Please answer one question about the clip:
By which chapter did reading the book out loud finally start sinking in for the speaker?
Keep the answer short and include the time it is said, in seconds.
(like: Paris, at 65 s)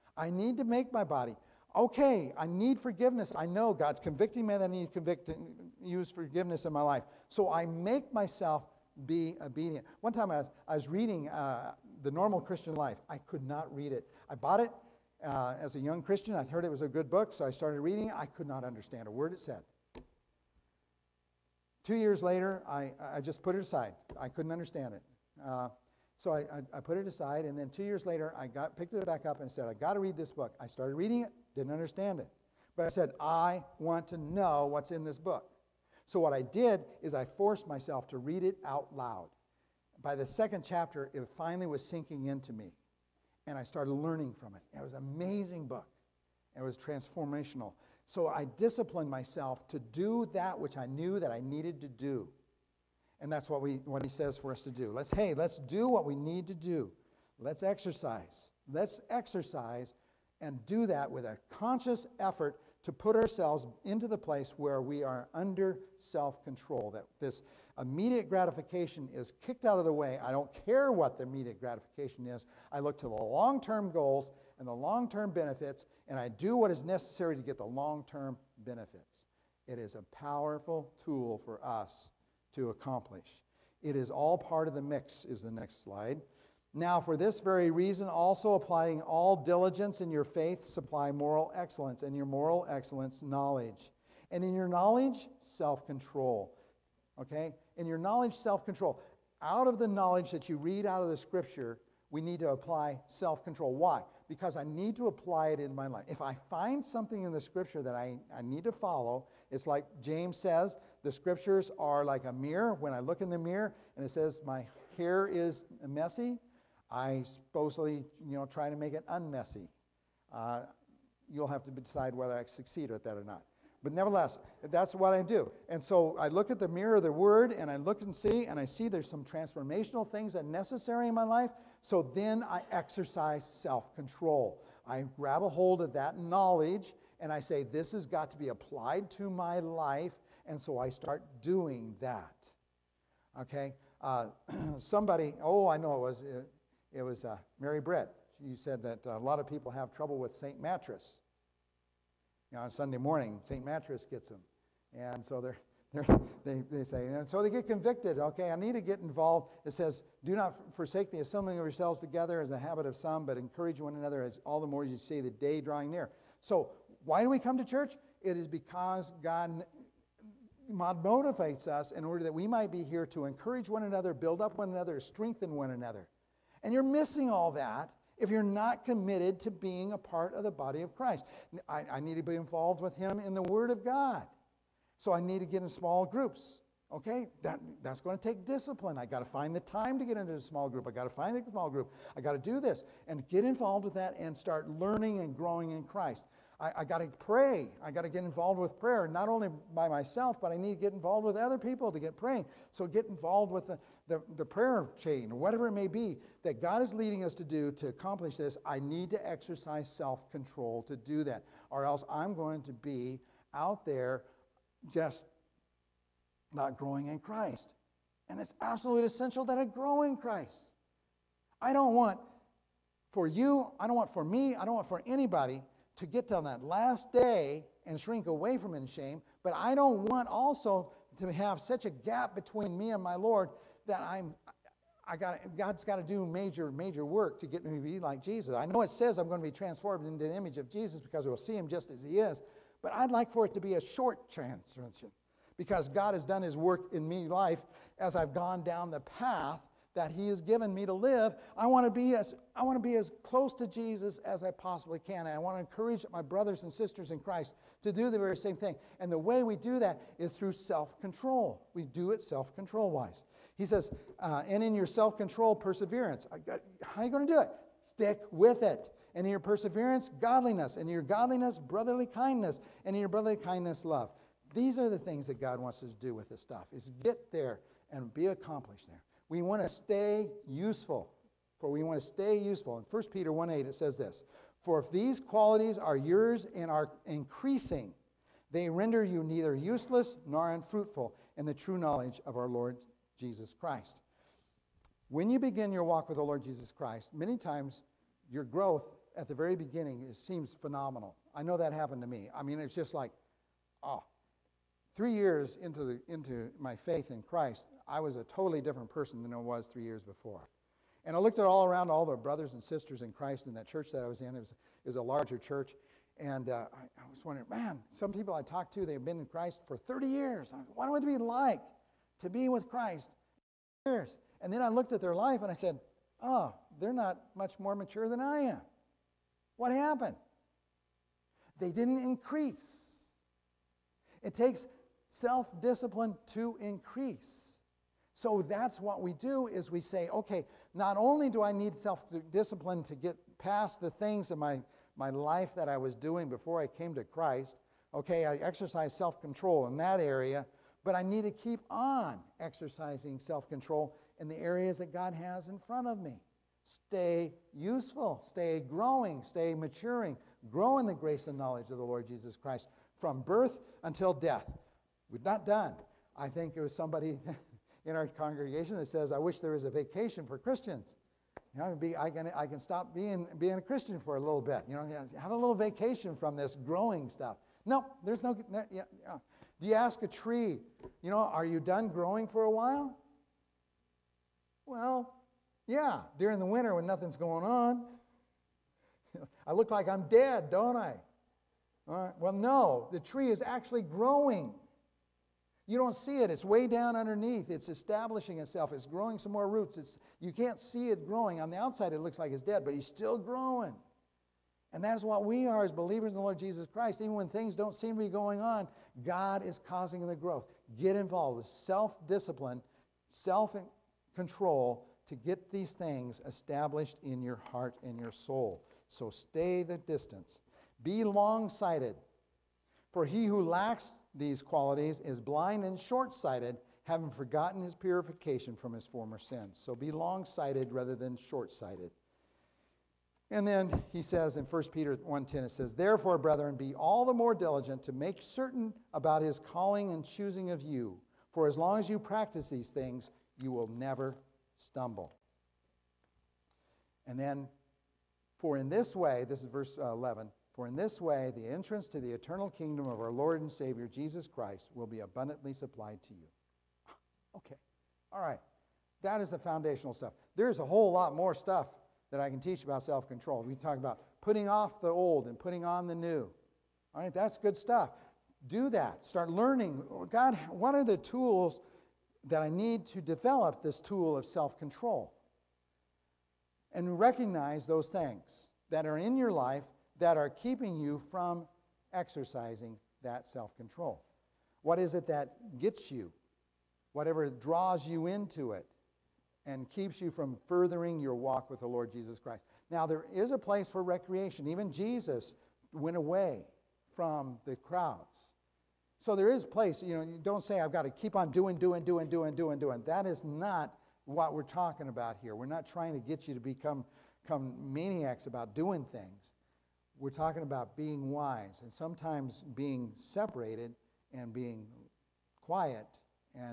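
second chapter, at 40 s.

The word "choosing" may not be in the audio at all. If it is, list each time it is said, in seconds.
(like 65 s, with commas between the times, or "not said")
440 s.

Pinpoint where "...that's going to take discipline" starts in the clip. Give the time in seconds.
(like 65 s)
187 s.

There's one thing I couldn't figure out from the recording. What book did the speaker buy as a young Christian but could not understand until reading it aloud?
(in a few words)
The Normal Christian Life.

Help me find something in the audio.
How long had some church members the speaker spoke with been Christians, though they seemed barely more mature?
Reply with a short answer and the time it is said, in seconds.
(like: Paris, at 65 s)
30 years, at 319 s.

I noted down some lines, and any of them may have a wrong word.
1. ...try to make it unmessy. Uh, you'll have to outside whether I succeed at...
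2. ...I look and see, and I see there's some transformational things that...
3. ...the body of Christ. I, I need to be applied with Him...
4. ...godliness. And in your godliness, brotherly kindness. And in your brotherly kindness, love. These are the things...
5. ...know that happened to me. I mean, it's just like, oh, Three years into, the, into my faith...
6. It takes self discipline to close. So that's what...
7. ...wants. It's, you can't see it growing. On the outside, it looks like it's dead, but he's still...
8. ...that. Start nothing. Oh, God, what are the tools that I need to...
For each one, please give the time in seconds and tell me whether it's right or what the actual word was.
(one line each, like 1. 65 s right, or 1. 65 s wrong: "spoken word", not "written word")
1. 118 s wrong: "decide", not "outside"
2. 127 s right
3. 180 s wrong: "involved", not "applied"
4. 270 s right
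5. 301 s right
6. 334 s wrong: "increase", not "close"
7. 399 s wrong: "roots", not "wants"
8. 468 s wrong: "learning", not "nothing".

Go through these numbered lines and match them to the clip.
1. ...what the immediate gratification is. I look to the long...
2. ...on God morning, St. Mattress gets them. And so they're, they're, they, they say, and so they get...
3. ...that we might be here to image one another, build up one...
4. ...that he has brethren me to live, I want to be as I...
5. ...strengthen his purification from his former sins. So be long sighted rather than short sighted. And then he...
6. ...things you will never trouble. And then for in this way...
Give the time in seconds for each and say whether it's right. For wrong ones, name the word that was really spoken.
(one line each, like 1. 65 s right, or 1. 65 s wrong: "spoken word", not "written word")
1. 70 s right
2. 152 s wrong: "Sunday", not "God"
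3. 172 s wrong: "encourage", not "image"
4. 249 s wrong: "given", not "brethren"
5. 427 s wrong: "forgotten", not "strengthen"
6. 442 s wrong: "stumble", not "trouble".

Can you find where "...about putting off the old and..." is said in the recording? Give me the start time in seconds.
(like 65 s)
463 s.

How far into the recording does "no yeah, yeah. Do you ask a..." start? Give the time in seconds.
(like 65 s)
378 s.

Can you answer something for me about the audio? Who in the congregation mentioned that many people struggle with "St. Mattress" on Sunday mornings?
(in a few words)
Mary Brett.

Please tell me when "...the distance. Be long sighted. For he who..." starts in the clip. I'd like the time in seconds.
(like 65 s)
419 s.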